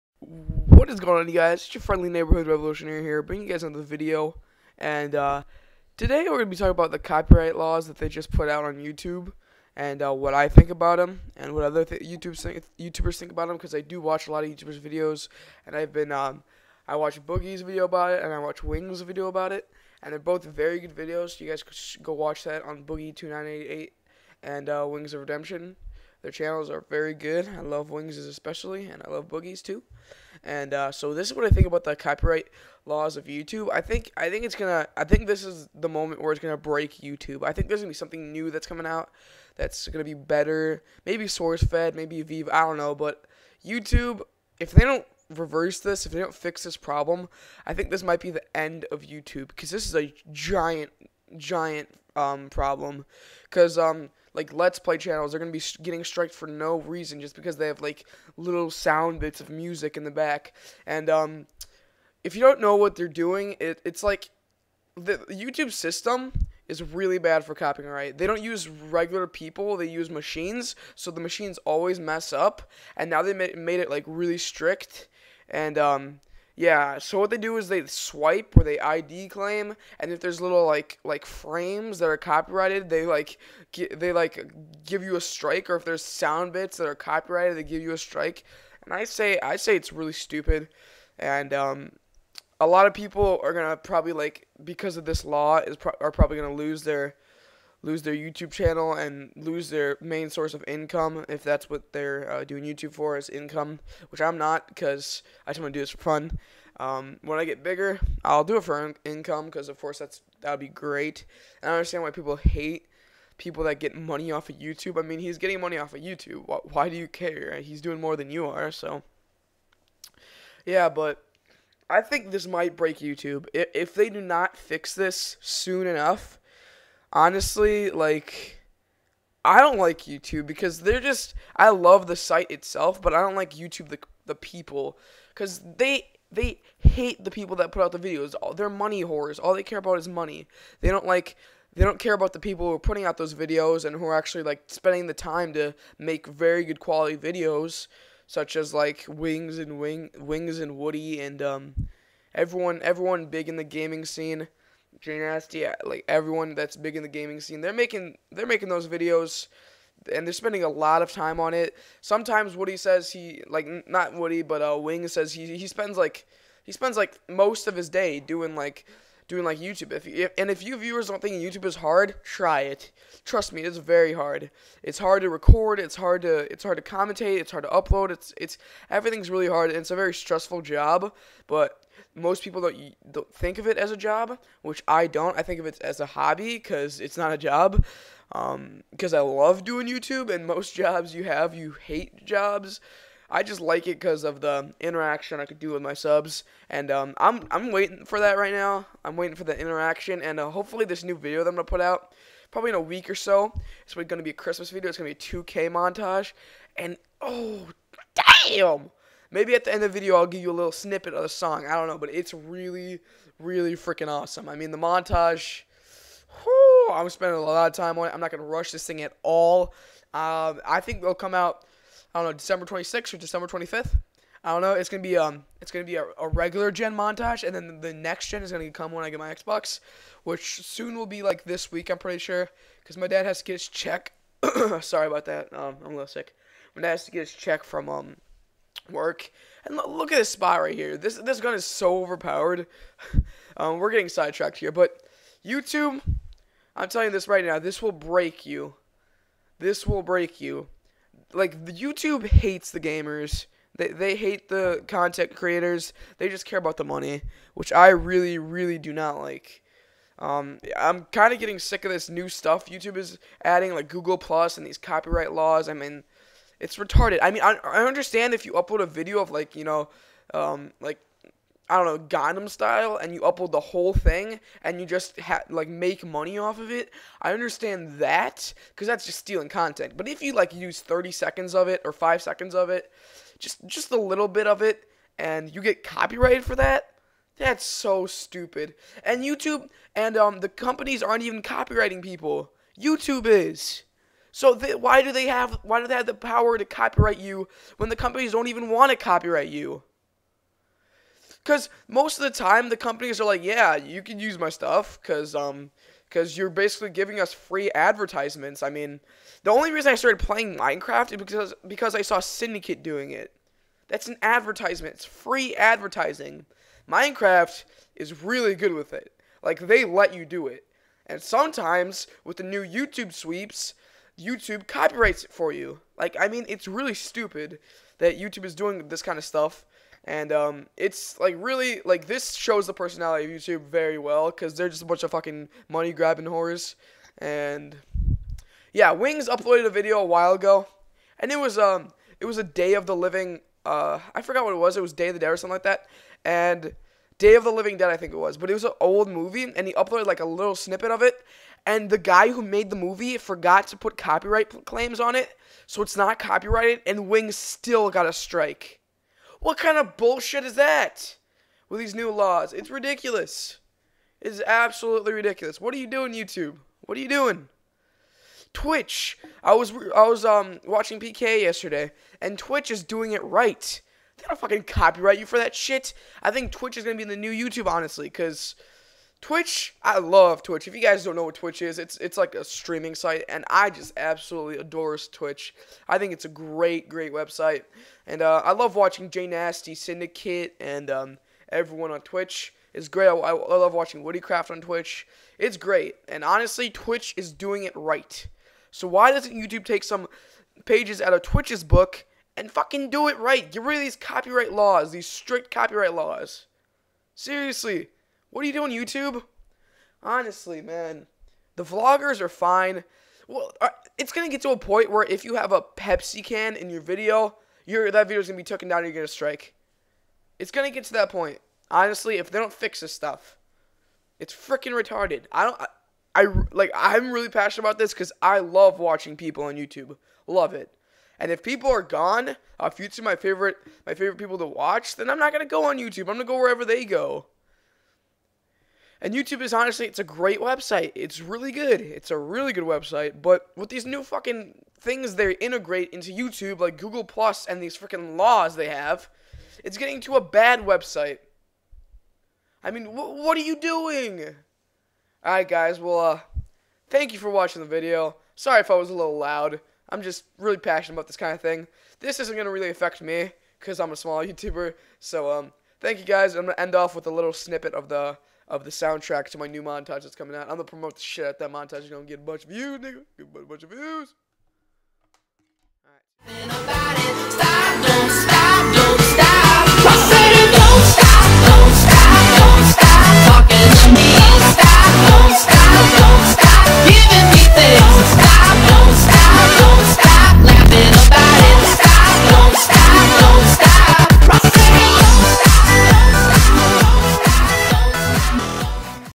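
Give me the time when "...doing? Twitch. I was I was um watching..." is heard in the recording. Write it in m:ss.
6:07.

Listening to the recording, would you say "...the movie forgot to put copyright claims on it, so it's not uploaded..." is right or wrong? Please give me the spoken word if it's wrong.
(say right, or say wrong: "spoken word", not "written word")
wrong: "copyrighted", not "uploaded".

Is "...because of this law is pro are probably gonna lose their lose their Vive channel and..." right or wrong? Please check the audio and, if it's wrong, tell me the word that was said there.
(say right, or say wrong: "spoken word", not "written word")
wrong: "YouTube", not "Vive".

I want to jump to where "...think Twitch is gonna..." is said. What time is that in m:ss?
6:16.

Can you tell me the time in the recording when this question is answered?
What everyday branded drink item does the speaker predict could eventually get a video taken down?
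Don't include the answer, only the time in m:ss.
6:55.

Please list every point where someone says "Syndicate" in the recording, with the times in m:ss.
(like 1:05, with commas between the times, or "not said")
5:12, 6:29.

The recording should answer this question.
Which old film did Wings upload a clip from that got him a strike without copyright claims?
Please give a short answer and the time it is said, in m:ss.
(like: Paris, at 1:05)
Day of the Living Dead, at 5:47.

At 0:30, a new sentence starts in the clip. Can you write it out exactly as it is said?
And uh, so this is what I think about the copyright laws of YouTube.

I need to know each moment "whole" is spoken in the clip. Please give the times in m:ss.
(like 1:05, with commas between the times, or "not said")
4:33.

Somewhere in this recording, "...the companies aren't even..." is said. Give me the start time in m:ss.
4:50.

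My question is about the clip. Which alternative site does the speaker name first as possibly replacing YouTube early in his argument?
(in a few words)
SourceFed.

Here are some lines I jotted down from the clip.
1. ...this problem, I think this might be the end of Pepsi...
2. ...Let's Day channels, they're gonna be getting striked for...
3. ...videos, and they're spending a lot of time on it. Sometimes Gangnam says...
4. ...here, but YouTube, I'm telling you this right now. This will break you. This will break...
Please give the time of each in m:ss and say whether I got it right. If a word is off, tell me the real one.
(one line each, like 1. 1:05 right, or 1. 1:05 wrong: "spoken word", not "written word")
1. 0:46 wrong: "YouTube", not "Pepsi"
2. 0:54 wrong: "Play", not "Day"
3. 2:38 wrong: "Woody", not "Gangnam"
4. 4:04 right.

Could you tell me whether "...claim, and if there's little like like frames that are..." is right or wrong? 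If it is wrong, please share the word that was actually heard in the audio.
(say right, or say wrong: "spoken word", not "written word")
right.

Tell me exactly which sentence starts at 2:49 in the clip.
If, if and if you viewers don't think YouTube is hard, try it.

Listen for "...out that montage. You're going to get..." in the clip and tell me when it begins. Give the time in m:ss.
7:51.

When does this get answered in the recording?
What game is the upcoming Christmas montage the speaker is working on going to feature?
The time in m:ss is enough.
3:25.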